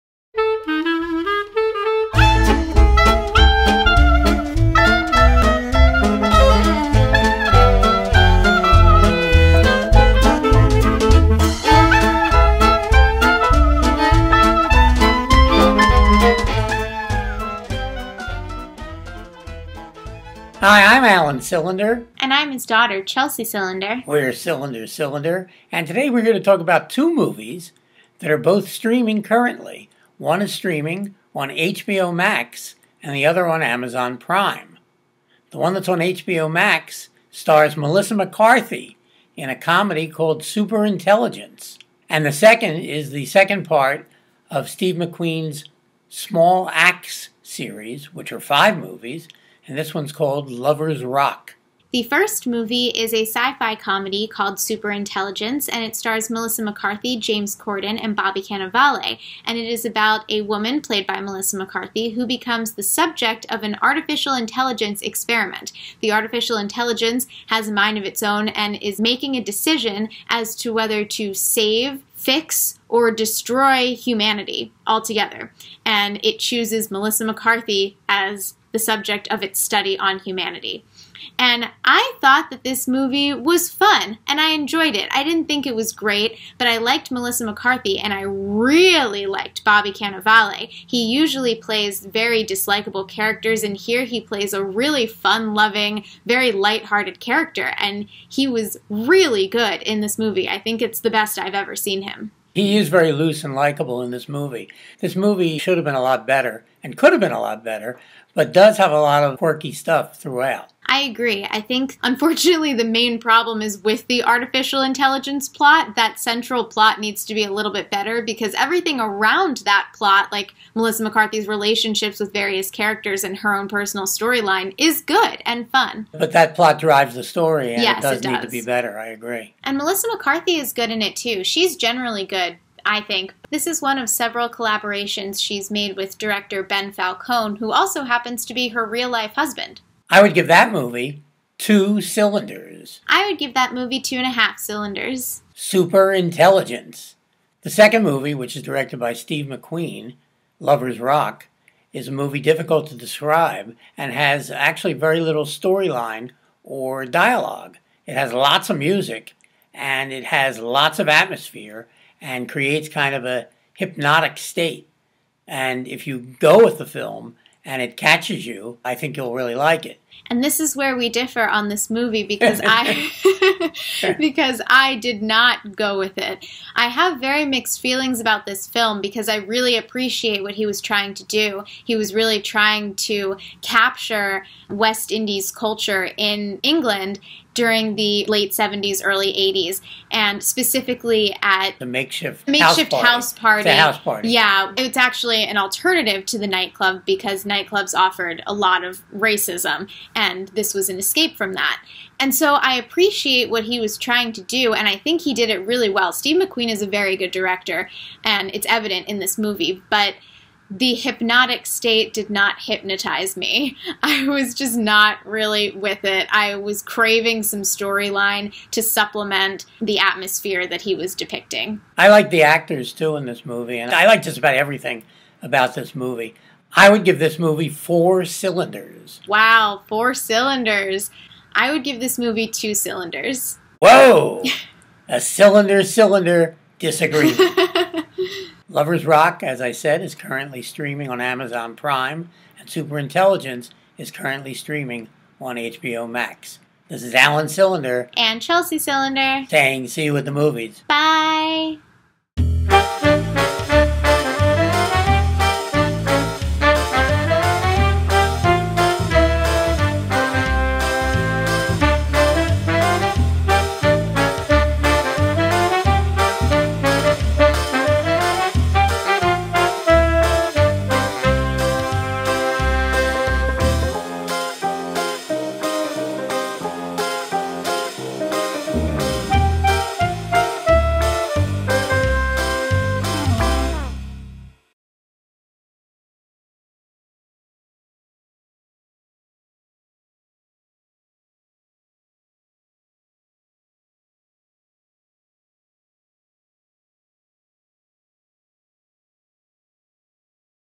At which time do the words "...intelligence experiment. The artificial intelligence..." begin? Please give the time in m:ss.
1:04.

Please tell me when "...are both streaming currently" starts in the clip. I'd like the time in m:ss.
0:28.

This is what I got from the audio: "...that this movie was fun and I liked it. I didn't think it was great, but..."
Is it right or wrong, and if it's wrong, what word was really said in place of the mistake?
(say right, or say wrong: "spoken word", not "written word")
wrong: "enjoyed", not "liked".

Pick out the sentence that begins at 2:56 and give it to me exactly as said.
I have very mixed feelings about this film because I really appreciate what he was trying to do.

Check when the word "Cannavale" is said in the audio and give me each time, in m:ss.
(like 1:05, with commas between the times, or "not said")
0:58, 1:29.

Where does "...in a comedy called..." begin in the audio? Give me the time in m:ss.
0:39.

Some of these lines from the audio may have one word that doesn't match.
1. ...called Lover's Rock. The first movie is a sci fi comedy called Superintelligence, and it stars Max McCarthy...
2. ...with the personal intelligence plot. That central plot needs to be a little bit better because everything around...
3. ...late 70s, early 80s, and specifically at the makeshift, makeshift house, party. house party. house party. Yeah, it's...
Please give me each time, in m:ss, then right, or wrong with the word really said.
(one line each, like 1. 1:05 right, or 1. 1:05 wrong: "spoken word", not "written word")
1. 0:50 wrong: "Melissa", not "Max"
2. 1:53 wrong: "artificial", not "personal"
3. 3:08 right.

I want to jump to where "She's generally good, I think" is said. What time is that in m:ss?
2:11.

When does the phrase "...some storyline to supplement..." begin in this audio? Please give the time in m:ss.
3:37.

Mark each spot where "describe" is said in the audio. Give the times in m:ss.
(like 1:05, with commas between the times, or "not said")
2:32.